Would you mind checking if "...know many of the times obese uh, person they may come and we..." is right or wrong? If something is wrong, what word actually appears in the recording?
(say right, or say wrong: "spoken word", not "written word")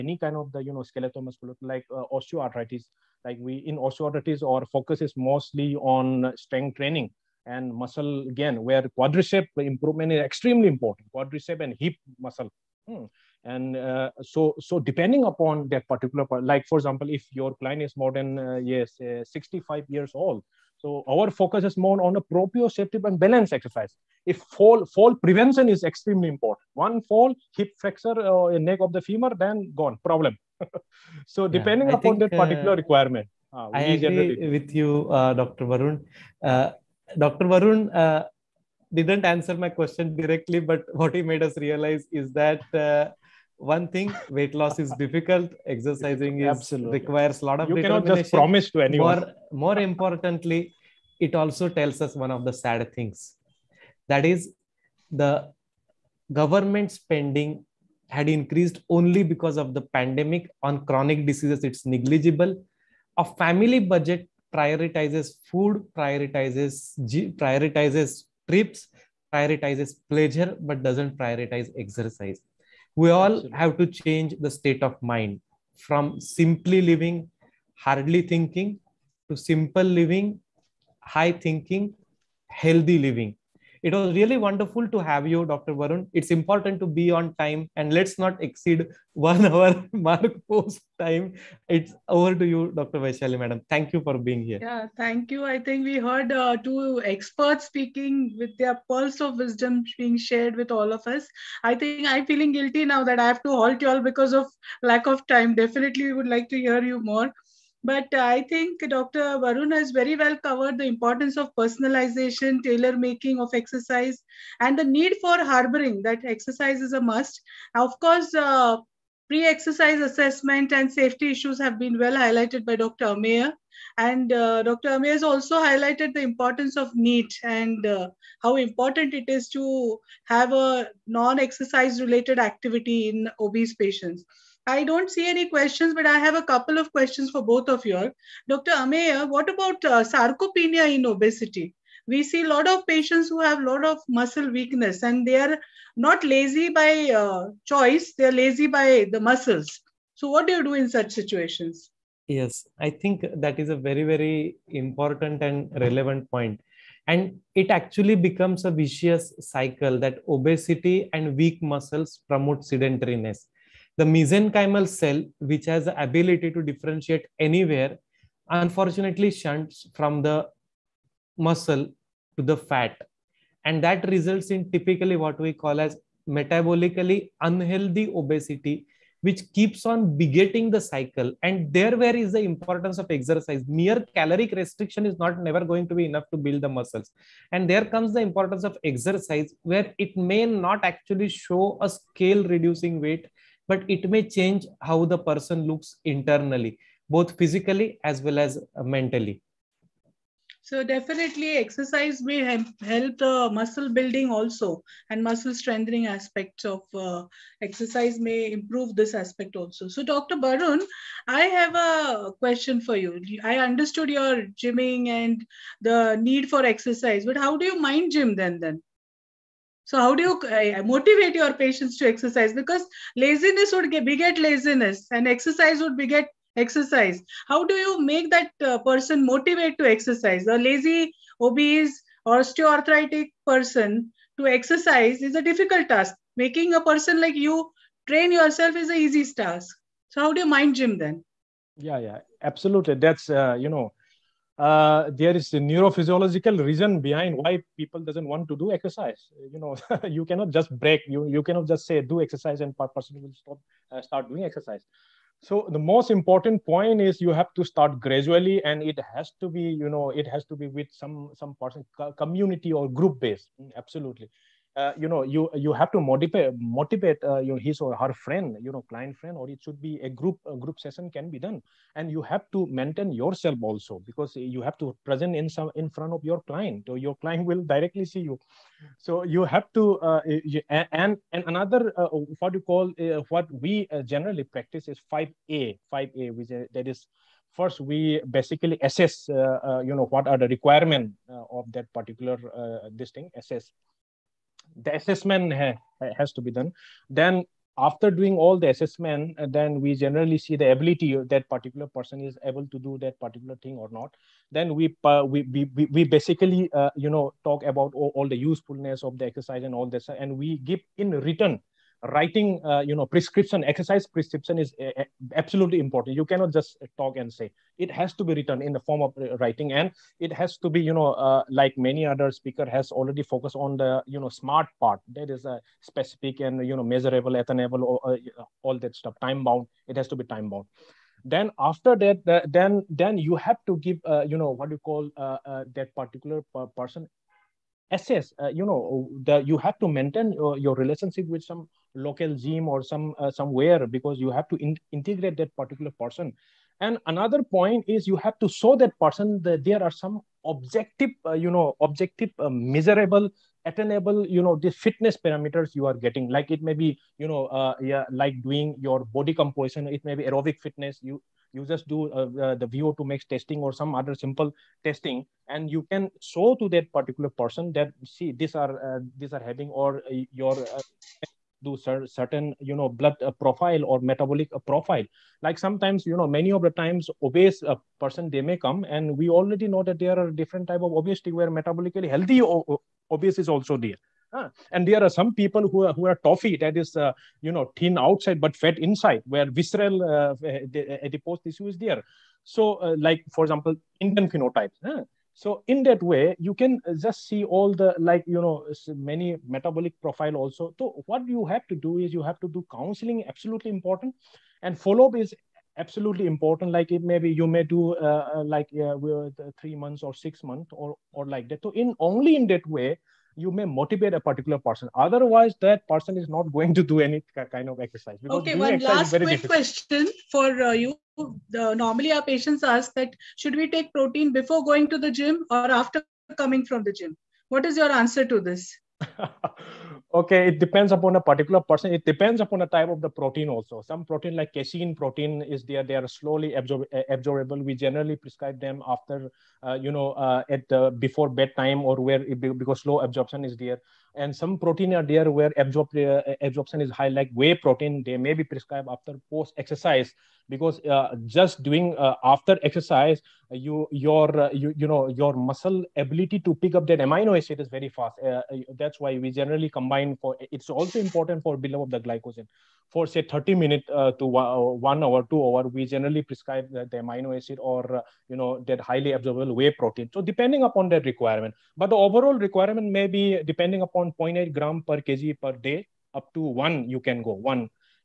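right.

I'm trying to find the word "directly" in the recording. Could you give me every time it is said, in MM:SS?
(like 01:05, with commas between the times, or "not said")
00:40, 04:37.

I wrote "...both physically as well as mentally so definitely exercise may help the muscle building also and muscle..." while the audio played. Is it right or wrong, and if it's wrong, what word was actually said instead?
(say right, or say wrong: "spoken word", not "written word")
right.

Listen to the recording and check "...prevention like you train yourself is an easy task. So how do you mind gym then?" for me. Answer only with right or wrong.
wrong.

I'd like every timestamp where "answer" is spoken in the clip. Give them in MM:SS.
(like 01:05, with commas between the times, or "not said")
00:39, 07:07.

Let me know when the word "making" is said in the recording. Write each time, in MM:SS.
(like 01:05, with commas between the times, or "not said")
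01:53, 03:56.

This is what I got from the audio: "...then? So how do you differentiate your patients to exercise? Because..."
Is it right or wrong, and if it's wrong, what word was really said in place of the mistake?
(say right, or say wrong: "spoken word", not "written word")
wrong: "motivate", not "differentiate".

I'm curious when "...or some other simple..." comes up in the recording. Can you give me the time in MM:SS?
06:03.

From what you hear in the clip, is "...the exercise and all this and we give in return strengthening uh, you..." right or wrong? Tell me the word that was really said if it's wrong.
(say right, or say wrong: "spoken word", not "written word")
wrong: "writing", not "strengthening".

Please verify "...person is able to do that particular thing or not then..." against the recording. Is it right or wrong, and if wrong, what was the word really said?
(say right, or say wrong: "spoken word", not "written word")
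right.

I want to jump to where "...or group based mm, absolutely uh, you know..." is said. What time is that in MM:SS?
04:22.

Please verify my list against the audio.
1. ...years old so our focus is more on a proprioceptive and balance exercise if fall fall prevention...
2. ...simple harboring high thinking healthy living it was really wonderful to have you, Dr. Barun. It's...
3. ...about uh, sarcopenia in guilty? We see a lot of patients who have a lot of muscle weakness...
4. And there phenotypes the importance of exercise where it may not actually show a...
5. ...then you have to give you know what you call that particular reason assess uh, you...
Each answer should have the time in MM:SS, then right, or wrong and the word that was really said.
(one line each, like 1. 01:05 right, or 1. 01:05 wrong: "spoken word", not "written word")
1. 00:19 right
2. 01:19 wrong: "living", not "harboring"
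3. 02:19 wrong: "obesity", not "guilty"
4. 03:07 wrong: "comes", not "phenotypes"
5. 05:32 wrong: "person", not "reason".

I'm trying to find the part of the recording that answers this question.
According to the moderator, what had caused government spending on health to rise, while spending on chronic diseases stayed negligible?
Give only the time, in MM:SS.
00:59.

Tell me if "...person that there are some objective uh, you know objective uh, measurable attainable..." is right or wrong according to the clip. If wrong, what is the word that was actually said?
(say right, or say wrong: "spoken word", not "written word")
right.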